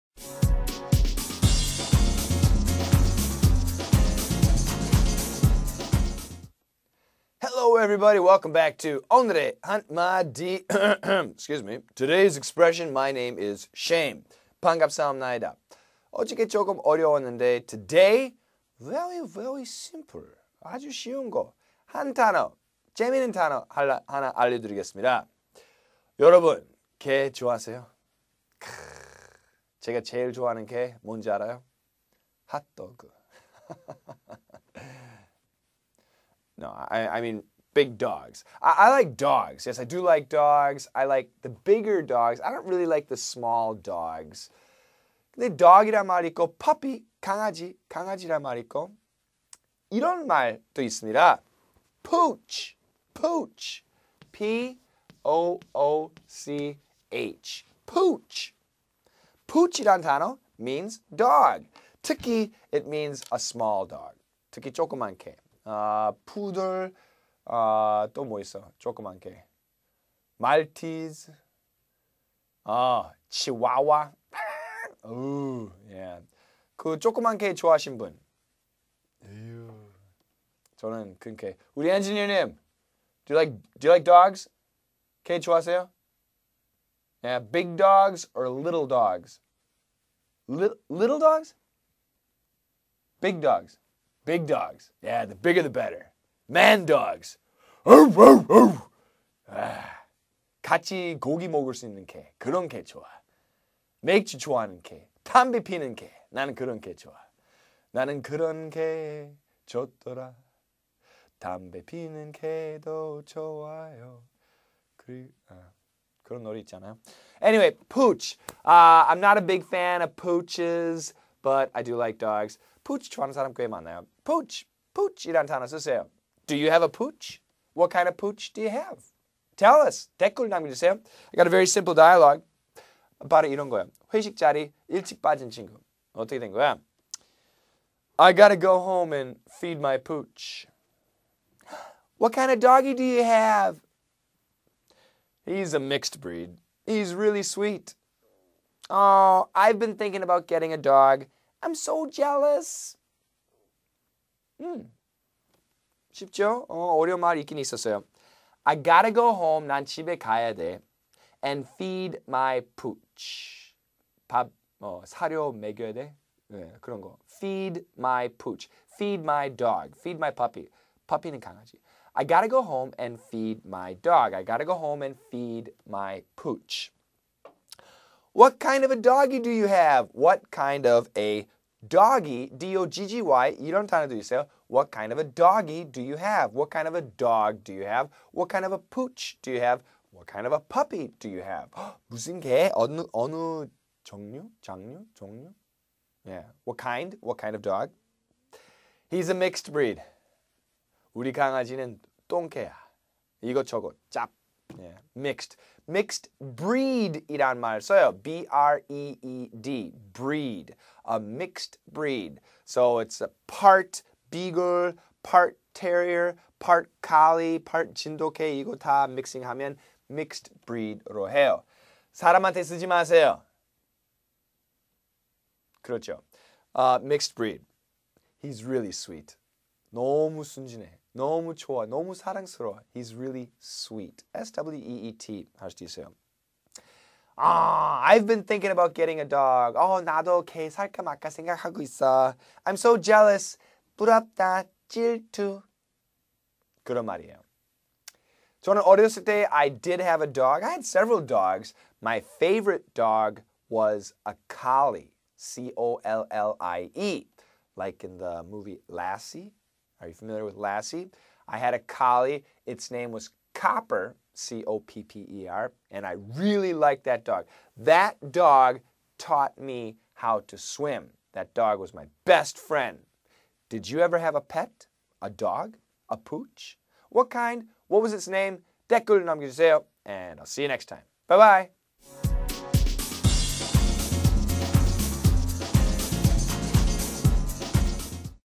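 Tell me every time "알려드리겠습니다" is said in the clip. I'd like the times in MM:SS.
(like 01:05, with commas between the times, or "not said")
00:24.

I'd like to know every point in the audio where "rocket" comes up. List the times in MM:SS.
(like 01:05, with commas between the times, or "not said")
not said.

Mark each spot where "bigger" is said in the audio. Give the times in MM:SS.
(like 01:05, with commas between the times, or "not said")
00:41, 01:35.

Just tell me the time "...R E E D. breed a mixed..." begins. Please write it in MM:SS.
03:28.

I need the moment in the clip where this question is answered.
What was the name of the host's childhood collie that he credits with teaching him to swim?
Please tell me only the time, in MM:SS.
04:23.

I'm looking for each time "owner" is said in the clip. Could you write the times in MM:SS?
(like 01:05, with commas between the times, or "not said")
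not said.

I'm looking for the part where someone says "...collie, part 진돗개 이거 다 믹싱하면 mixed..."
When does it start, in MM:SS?
03:37.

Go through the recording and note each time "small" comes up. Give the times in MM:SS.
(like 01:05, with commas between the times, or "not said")
00:43, 01:03.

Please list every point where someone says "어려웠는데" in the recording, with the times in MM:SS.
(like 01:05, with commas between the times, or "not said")
00:16.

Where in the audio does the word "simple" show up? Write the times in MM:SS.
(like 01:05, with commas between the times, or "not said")
00:19, 02:11.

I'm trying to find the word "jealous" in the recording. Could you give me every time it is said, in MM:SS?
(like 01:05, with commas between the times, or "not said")
02:32, 04:02.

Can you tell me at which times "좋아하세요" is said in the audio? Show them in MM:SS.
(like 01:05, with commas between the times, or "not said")
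00:27, 01:25.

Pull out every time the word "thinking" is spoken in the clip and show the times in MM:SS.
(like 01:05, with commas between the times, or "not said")
02:29, 03:58.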